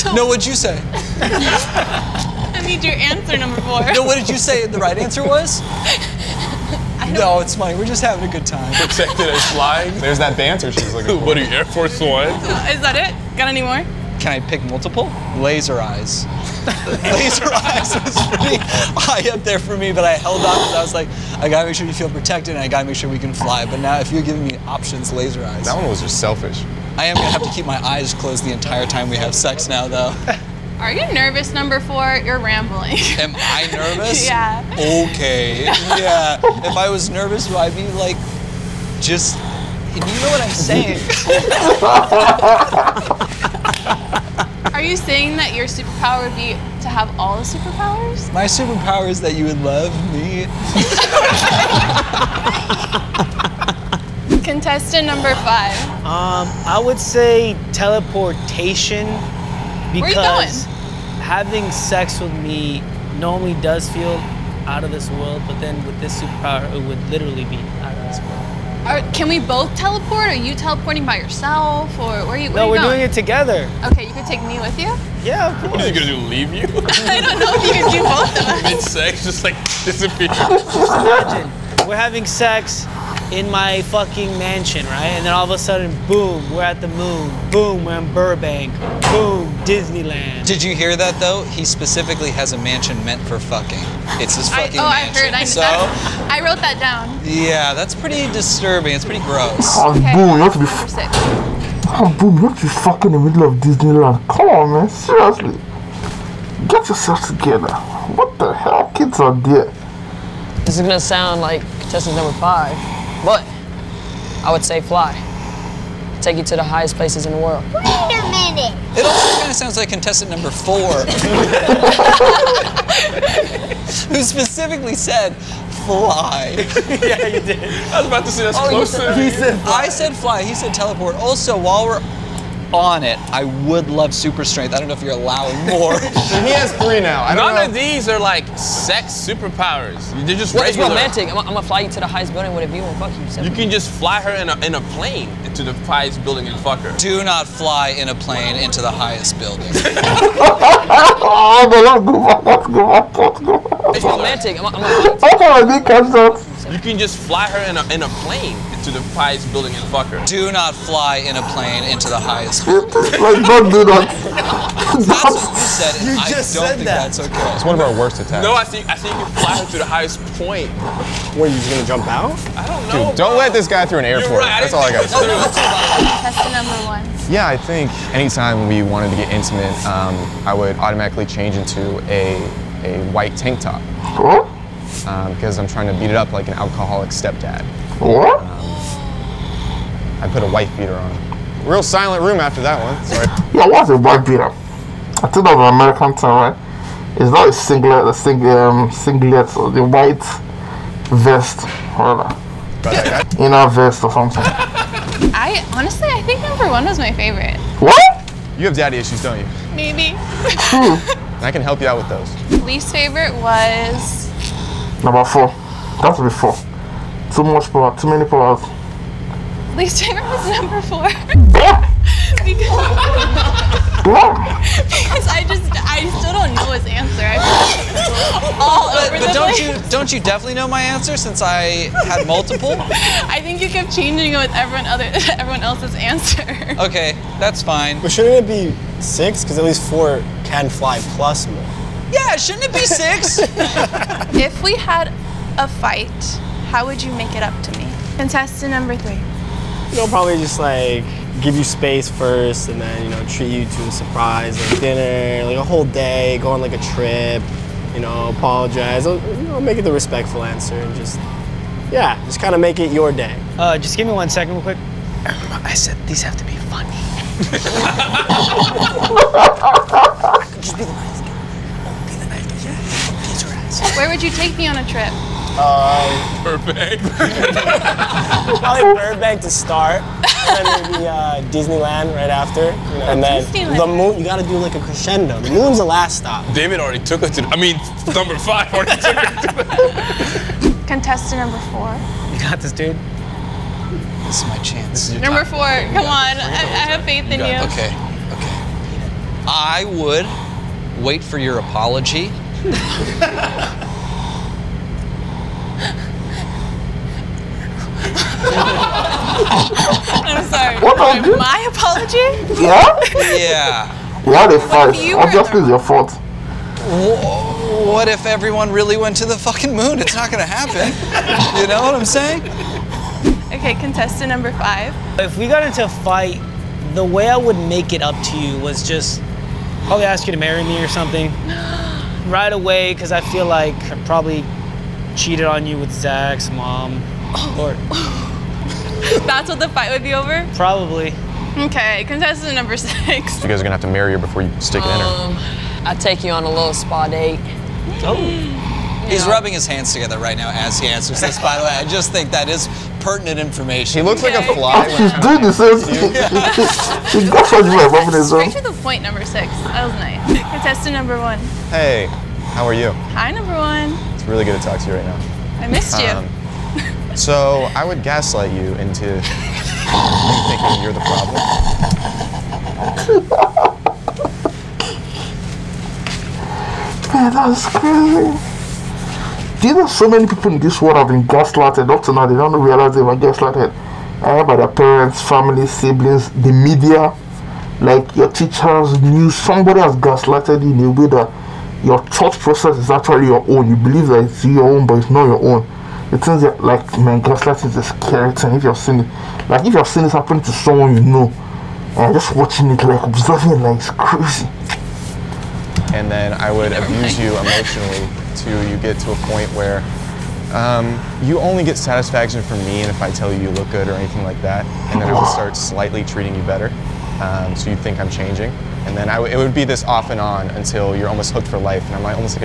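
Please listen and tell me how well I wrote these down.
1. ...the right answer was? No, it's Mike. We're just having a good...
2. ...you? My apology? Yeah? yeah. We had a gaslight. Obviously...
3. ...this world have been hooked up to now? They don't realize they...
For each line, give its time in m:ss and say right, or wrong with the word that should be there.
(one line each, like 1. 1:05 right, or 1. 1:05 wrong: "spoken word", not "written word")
1. 0:04 right
2. 5:11 wrong: "fight", not "gaslight"
3. 6:20 wrong: "gaslighted", not "hooked".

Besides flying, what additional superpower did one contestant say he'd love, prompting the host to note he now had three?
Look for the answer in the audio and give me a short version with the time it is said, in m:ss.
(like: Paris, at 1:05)
Super strength, at 2:14.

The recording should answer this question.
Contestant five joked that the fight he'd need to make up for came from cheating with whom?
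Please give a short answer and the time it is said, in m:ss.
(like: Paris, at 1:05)
Zach's mom, at 5:35.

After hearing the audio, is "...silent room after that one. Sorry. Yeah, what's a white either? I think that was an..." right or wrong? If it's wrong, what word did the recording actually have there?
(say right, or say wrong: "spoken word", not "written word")
wrong: "beater", not "either".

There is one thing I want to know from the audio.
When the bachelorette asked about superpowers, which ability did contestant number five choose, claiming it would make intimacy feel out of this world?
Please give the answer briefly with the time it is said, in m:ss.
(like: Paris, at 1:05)
Teleportation, at 0:57.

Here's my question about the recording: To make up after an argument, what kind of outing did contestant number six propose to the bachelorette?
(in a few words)
Spa date.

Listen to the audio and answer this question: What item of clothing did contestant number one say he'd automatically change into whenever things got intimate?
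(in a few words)
White tank top.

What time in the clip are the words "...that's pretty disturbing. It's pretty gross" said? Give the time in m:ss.
1:37.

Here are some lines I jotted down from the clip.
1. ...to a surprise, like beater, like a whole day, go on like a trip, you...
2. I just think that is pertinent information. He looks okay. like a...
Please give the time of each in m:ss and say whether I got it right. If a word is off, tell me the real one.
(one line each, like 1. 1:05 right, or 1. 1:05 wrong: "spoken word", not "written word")
1. 4:13 wrong: "dinner", not "beater"
2. 5:51 right.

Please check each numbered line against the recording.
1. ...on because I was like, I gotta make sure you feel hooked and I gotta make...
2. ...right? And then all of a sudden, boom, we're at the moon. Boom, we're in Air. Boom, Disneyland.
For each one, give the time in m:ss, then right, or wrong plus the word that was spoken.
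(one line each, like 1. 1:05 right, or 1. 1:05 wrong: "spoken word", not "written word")
1. 0:20 wrong: "protected", not "hooked"
2. 1:24 wrong: "Burbank", not "Air".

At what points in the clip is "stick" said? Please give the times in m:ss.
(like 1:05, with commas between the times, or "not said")
5:44.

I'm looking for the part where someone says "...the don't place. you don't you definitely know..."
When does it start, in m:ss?
3:49.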